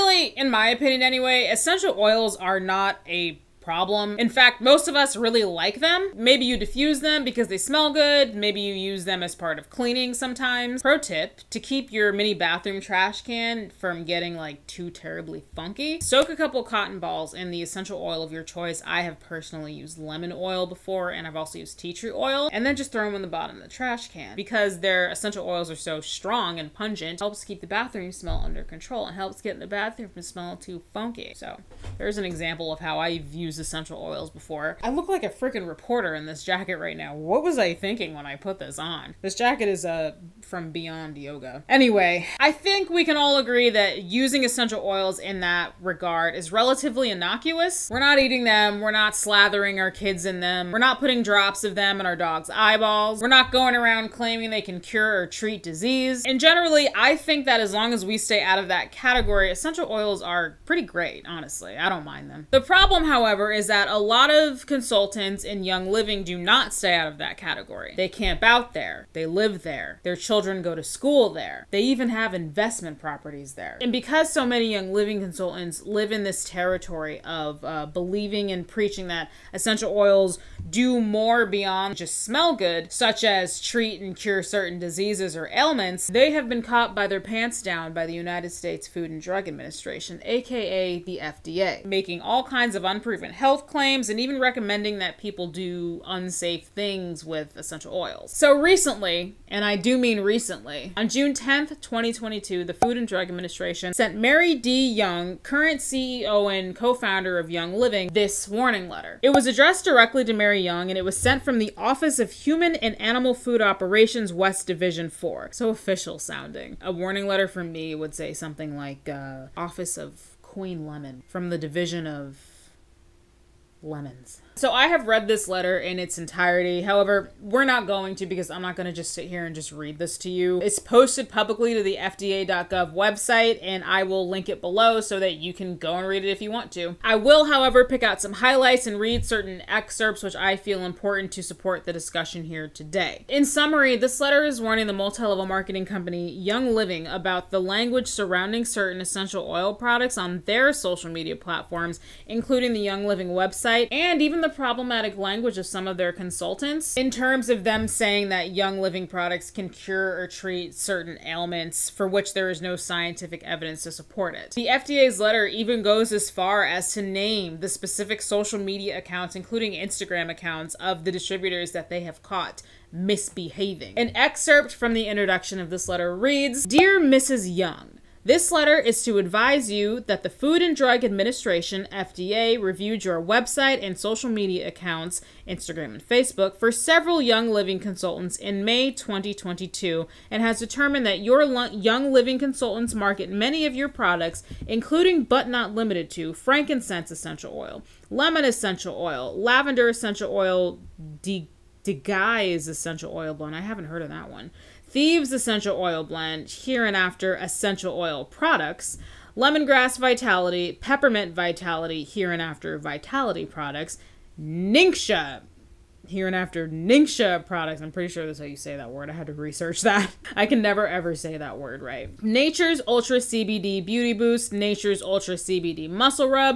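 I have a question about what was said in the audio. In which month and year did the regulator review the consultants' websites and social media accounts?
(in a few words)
May 2022.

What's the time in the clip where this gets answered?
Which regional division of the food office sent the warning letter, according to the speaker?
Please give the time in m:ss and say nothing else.
1:54.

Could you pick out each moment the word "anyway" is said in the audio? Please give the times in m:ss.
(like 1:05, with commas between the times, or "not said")
0:01, 0:41.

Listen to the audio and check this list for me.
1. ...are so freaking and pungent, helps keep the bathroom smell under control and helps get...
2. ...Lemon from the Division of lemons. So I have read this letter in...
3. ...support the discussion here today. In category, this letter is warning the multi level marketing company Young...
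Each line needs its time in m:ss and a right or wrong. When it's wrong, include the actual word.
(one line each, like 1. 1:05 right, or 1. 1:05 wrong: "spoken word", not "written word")
1. 0:25 wrong: "strong", not "freaking"
2. 2:00 right
3. 2:21 wrong: "summary", not "category".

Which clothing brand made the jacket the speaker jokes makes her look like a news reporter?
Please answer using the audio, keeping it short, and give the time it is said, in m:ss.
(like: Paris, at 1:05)
Beyond Yoga, at 0:40.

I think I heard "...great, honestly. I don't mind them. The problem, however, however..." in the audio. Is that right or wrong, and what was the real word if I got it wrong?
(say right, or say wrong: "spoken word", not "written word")
right.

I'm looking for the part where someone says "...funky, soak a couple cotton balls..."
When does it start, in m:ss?
0:15.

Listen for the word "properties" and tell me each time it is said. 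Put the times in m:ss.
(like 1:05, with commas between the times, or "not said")
1:12.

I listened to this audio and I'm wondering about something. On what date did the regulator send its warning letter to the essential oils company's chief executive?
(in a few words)
June 10, 2022.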